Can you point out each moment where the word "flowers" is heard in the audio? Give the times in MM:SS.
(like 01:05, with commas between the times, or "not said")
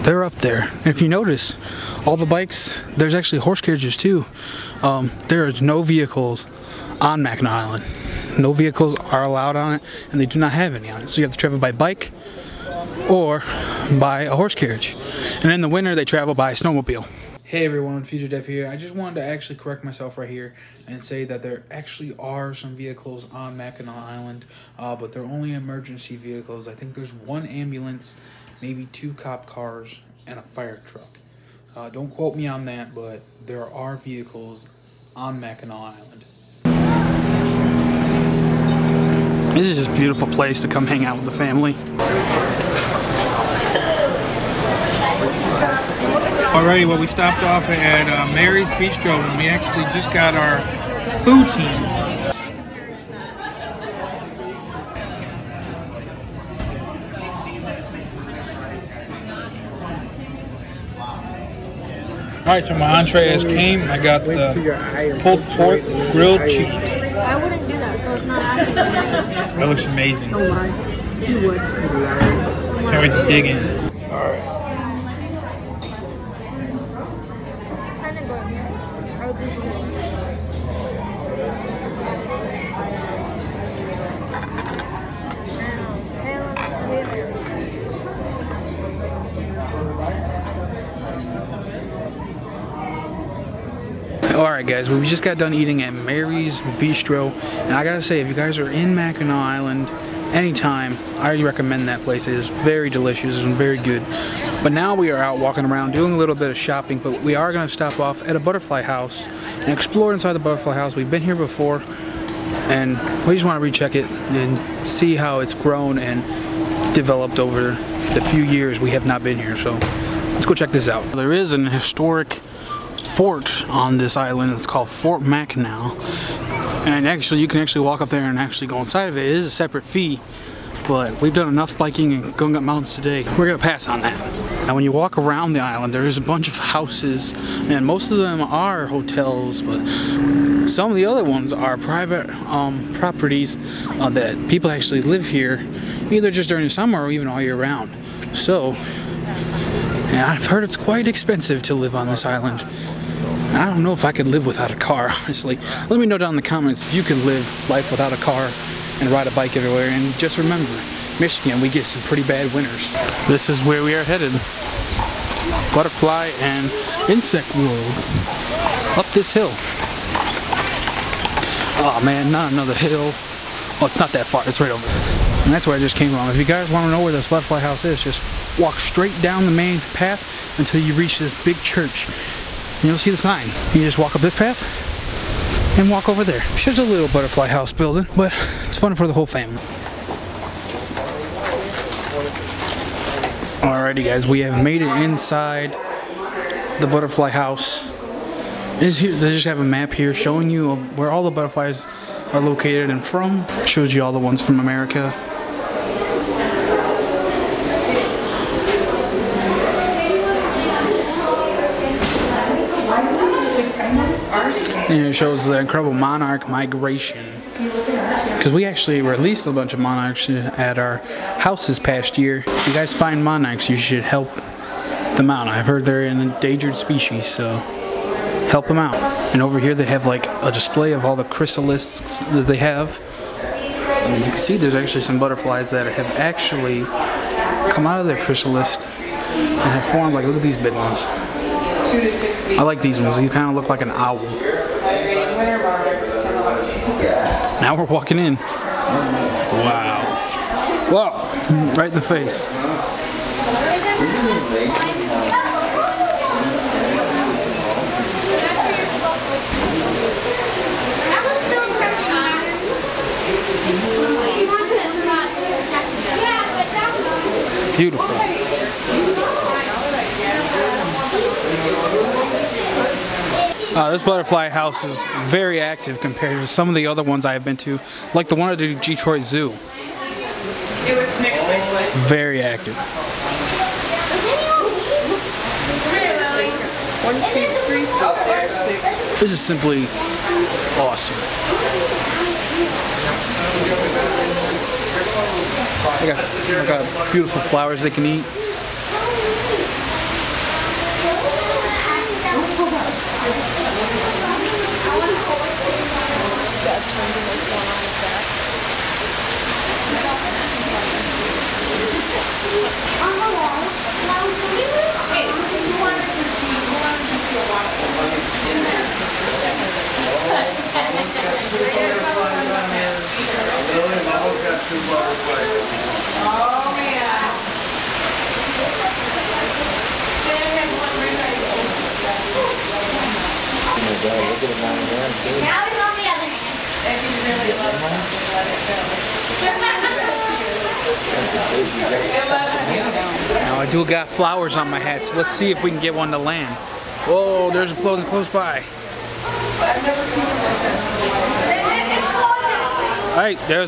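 04:57, 05:44.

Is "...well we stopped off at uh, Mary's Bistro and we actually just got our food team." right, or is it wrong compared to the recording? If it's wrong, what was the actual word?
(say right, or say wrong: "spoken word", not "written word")
right.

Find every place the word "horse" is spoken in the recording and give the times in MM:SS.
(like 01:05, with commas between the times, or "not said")
00:03, 00:14.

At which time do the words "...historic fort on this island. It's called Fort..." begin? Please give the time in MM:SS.
02:01.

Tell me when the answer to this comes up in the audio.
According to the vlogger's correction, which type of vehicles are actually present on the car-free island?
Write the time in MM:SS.
00:25.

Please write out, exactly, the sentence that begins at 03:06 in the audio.
It's just a little butterfly house building, but it's fun for the whole family.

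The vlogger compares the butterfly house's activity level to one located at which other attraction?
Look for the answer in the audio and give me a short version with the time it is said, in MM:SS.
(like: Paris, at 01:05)
Detroit Zoo, at 04:38.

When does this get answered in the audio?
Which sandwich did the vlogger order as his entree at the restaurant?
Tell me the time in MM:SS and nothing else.
01:05.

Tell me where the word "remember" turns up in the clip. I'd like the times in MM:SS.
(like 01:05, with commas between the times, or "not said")
02:40.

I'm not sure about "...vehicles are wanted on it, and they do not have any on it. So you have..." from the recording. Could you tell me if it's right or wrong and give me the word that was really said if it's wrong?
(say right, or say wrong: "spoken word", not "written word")
wrong: "allowed", not "wanted".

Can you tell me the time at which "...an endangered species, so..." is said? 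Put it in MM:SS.
03:46.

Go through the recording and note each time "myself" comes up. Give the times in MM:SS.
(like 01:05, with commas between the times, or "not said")
00:19.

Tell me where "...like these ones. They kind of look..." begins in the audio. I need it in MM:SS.
04:02.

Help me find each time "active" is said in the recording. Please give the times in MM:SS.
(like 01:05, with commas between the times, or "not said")
04:35, 04:42.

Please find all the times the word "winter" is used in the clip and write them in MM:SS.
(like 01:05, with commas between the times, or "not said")
00:15, 02:42.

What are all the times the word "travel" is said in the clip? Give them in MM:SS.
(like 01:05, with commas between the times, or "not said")
00:11, 00:16.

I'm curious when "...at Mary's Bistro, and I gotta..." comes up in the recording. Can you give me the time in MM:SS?
01:35.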